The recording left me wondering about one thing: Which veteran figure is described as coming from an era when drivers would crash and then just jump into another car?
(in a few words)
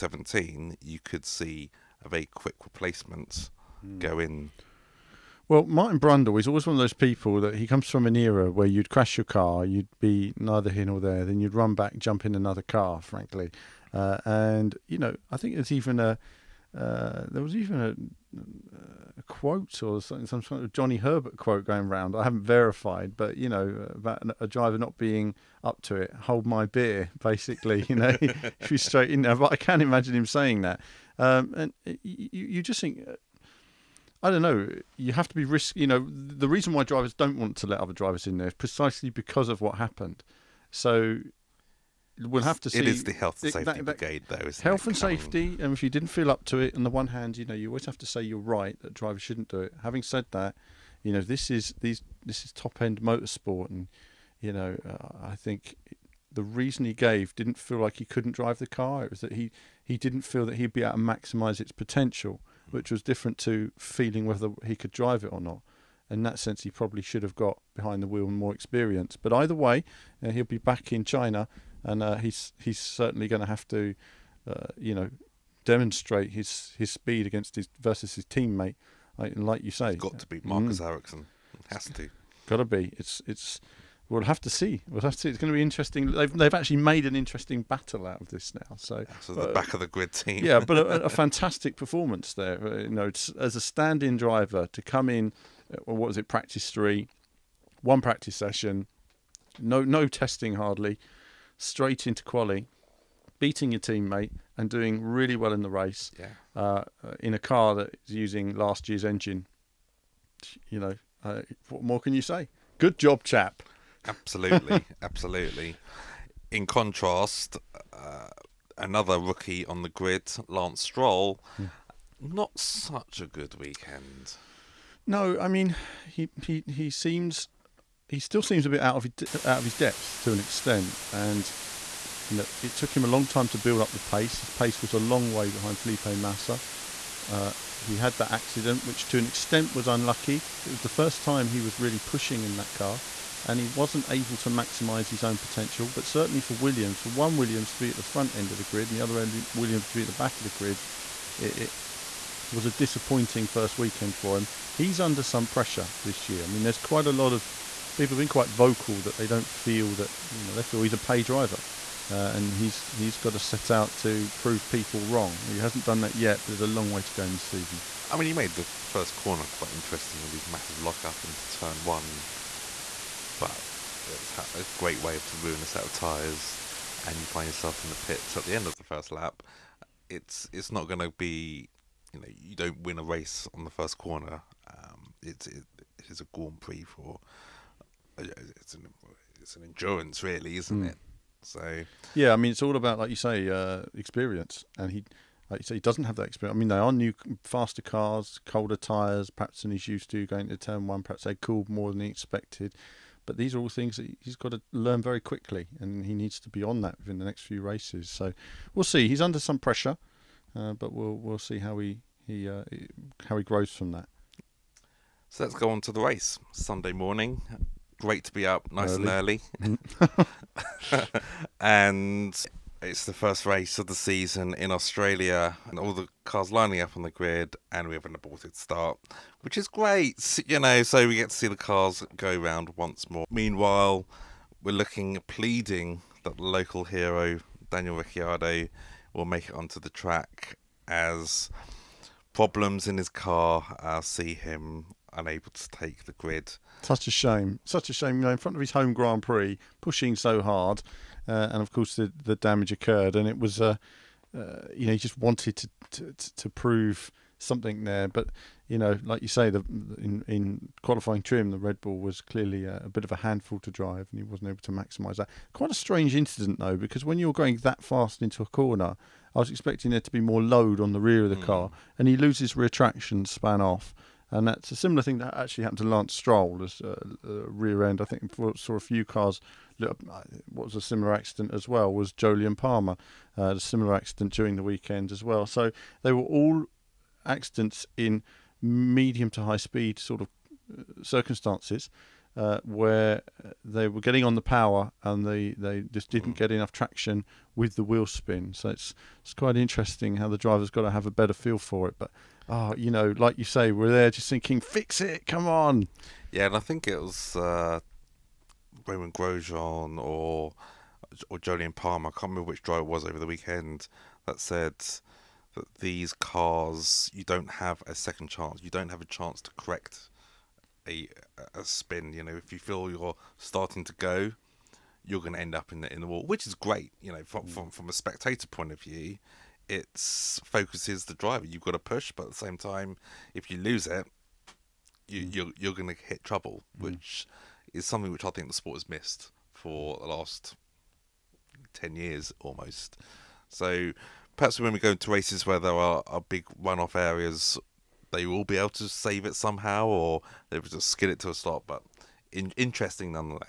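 Martin Brundle.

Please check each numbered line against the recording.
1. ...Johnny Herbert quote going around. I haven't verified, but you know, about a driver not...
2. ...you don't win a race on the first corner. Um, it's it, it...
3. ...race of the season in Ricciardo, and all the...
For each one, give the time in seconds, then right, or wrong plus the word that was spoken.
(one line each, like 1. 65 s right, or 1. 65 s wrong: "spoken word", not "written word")
1. 20 s right
2. 182 s right
3. 223 s wrong: "Australia", not "Ricciardo".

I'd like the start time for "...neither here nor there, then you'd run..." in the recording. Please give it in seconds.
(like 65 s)
10 s.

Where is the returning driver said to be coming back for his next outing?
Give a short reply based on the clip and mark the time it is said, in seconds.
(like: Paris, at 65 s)
China, at 71 s.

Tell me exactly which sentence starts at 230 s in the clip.
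So we get to see the cars go round once more.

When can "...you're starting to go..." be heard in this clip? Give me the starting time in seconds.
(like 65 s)
322 s.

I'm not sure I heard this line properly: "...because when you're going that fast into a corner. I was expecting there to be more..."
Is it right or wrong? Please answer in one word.
right.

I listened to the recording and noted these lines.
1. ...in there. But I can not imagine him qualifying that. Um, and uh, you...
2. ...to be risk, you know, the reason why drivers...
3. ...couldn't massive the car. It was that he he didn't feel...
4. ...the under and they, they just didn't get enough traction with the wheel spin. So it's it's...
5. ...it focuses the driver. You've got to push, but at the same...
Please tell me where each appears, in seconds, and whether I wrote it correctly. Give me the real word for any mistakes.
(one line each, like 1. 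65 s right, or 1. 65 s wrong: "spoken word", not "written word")
1. 29 s wrong: "saying", not "qualifying"
2. 35 s right
3. 58 s wrong: "drive", not "massive"
4. 294 s wrong: "power", not "under"
5. 329 s right.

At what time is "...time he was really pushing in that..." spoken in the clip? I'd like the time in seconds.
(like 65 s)
141 s.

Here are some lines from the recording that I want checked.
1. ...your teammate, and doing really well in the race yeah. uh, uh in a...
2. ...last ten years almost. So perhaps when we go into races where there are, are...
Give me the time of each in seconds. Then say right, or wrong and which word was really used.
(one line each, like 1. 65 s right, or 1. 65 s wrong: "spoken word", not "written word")
1. 103 s right
2. 340 s right.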